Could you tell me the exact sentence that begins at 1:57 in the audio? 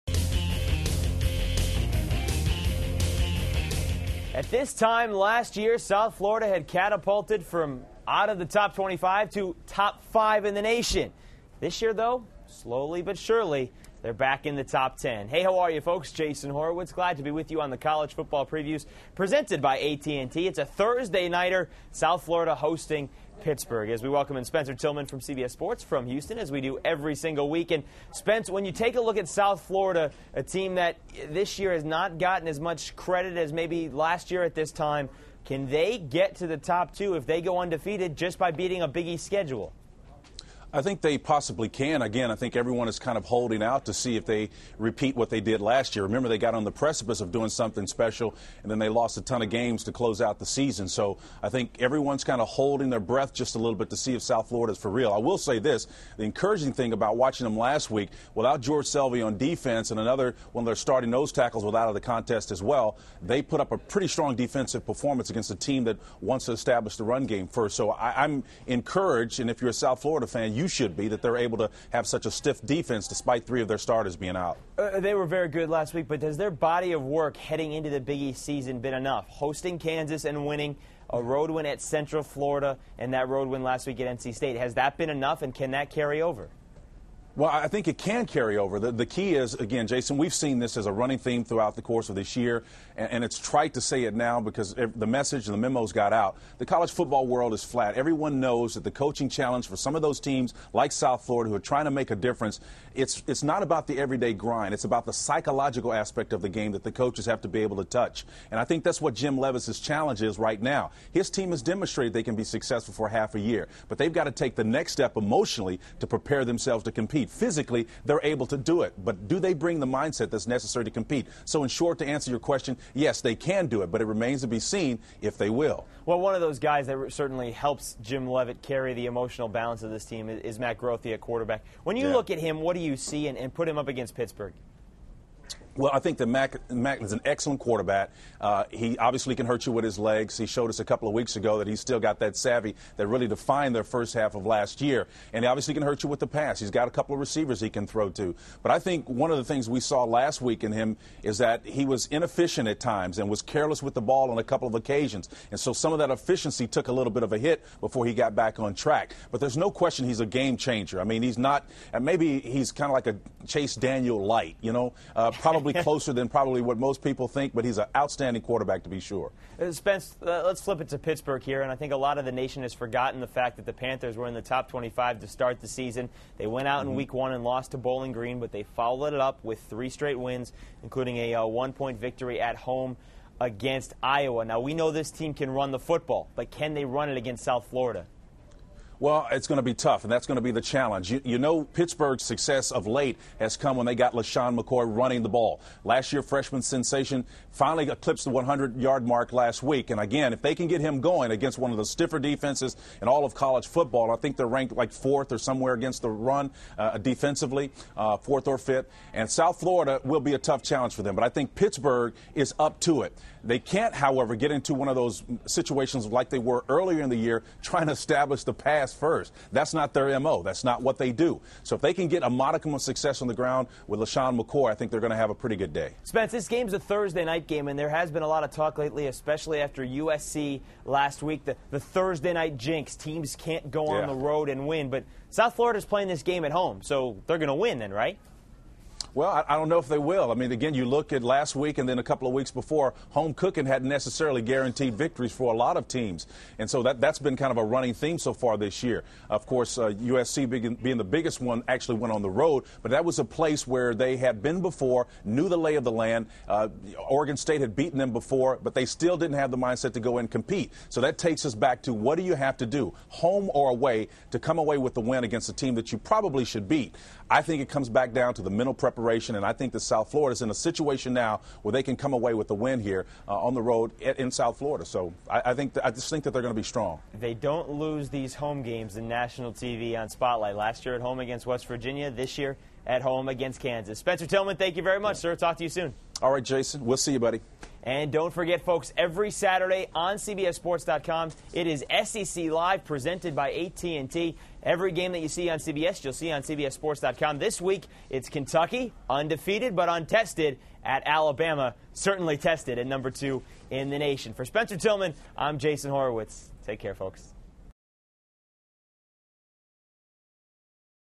Physically, they're able to do it, but do they bring the mindset that's necessary to compete?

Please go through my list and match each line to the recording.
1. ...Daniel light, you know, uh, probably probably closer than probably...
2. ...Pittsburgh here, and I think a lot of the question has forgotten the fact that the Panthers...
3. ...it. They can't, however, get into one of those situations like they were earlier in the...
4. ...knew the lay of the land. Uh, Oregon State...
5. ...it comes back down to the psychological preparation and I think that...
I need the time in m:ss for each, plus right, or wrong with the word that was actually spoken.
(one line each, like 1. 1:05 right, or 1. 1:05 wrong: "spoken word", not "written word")
1. 2:43 right
2. 2:50 wrong: "nation", not "question"
3. 3:33 right
4. 4:15 right
5. 4:27 wrong: "mental", not "psychological".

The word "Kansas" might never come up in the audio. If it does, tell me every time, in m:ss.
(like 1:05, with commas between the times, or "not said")
1:19, 4:43.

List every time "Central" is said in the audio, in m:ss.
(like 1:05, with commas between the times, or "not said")
1:21.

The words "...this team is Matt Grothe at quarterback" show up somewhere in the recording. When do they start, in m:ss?
2:09.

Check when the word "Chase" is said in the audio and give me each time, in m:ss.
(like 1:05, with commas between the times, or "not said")
2:43.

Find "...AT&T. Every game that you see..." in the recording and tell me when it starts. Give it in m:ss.
4:53.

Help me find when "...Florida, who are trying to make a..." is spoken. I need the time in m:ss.
1:41.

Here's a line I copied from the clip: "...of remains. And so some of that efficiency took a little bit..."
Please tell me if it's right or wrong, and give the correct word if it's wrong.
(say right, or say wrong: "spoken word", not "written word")
wrong: "occasions", not "remains".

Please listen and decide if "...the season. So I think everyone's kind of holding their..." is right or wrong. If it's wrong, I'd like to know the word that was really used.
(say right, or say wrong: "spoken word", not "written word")
right.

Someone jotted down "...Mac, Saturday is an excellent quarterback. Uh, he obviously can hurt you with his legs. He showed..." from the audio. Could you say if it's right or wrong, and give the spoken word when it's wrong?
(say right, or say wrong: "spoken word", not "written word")
wrong: "Mac", not "Saturday".